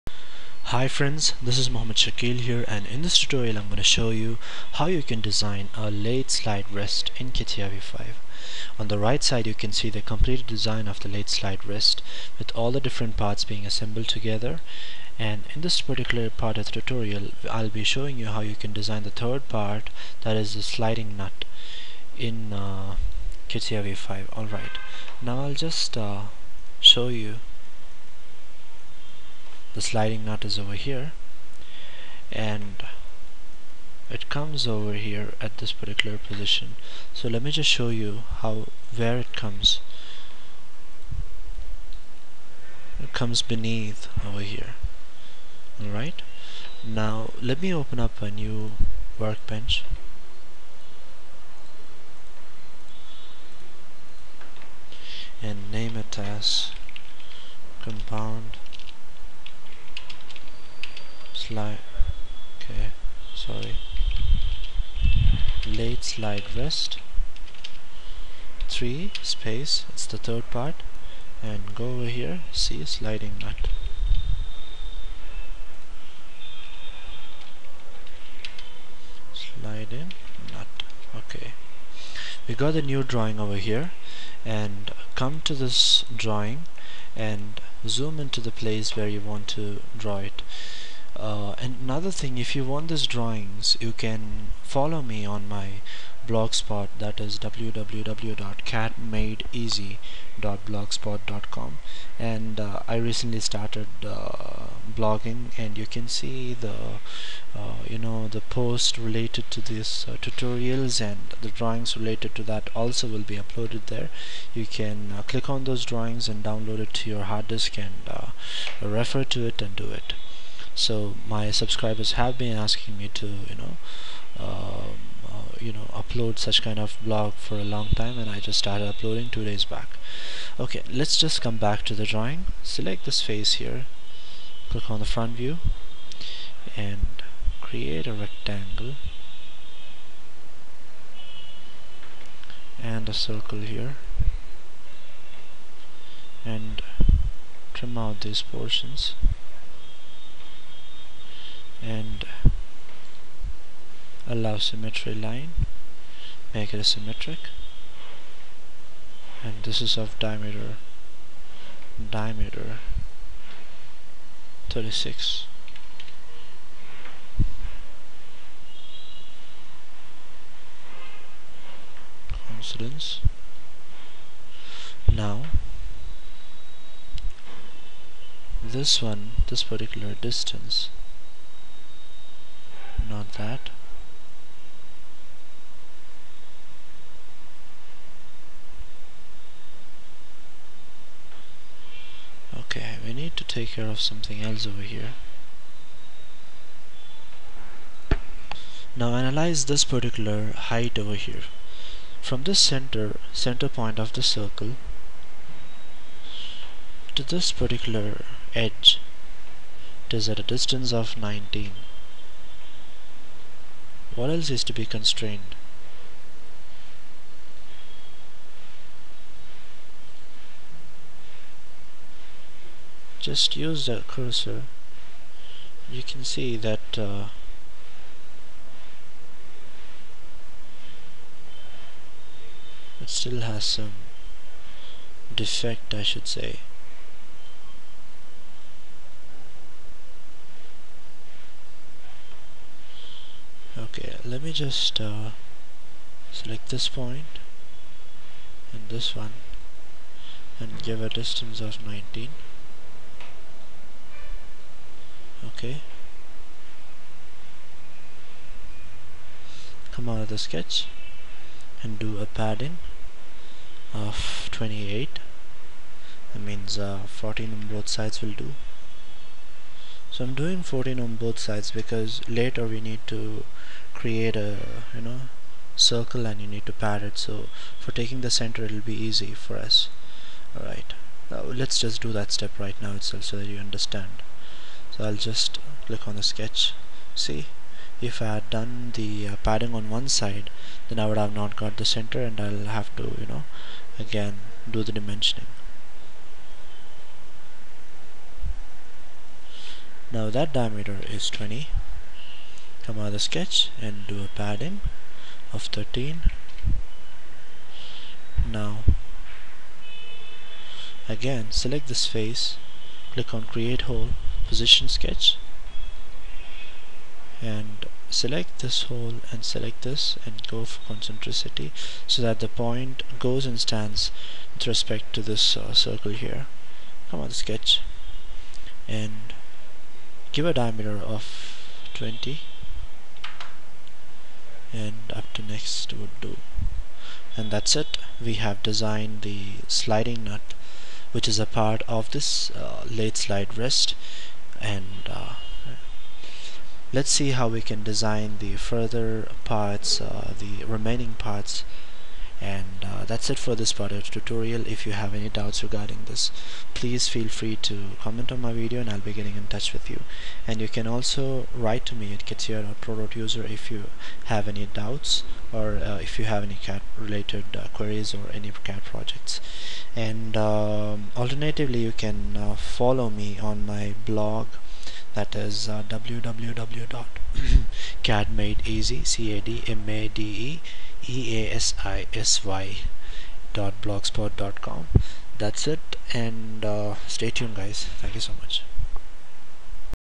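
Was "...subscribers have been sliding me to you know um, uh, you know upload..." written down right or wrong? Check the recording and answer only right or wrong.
wrong.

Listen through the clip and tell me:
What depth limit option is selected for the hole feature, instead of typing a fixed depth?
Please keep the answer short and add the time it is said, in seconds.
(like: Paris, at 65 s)
up to next, at 335 s.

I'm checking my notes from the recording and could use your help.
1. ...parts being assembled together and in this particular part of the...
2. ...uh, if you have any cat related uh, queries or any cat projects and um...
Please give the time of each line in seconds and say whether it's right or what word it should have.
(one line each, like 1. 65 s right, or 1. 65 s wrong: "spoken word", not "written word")
1. 13 s right
2. 365 s right.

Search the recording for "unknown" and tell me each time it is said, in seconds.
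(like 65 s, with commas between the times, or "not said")
not said.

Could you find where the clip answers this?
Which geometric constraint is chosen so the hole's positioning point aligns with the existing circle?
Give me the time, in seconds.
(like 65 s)
320 s.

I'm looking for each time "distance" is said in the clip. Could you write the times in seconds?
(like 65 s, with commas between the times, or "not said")
180 s, 210 s, 251 s.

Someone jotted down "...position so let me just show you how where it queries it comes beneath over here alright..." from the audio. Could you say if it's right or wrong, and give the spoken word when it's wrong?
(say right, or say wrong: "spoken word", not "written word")
wrong: "comes", not "queries".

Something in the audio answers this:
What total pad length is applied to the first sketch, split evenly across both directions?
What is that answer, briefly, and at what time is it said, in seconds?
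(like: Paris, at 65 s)
28, at 262 s.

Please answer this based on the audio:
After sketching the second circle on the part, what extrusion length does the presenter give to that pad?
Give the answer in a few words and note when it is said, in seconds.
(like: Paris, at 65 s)
13, at 304 s.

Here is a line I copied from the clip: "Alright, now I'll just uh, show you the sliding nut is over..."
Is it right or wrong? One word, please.
right.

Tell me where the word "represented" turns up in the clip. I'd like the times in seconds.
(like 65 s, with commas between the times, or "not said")
not said.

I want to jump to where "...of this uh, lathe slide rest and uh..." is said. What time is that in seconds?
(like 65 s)
341 s.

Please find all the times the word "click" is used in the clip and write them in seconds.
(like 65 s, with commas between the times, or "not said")
115 s, 134 s, 285 s, 313 s.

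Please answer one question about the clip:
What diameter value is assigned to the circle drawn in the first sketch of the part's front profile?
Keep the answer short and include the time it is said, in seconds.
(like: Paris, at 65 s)
36, at 162 s.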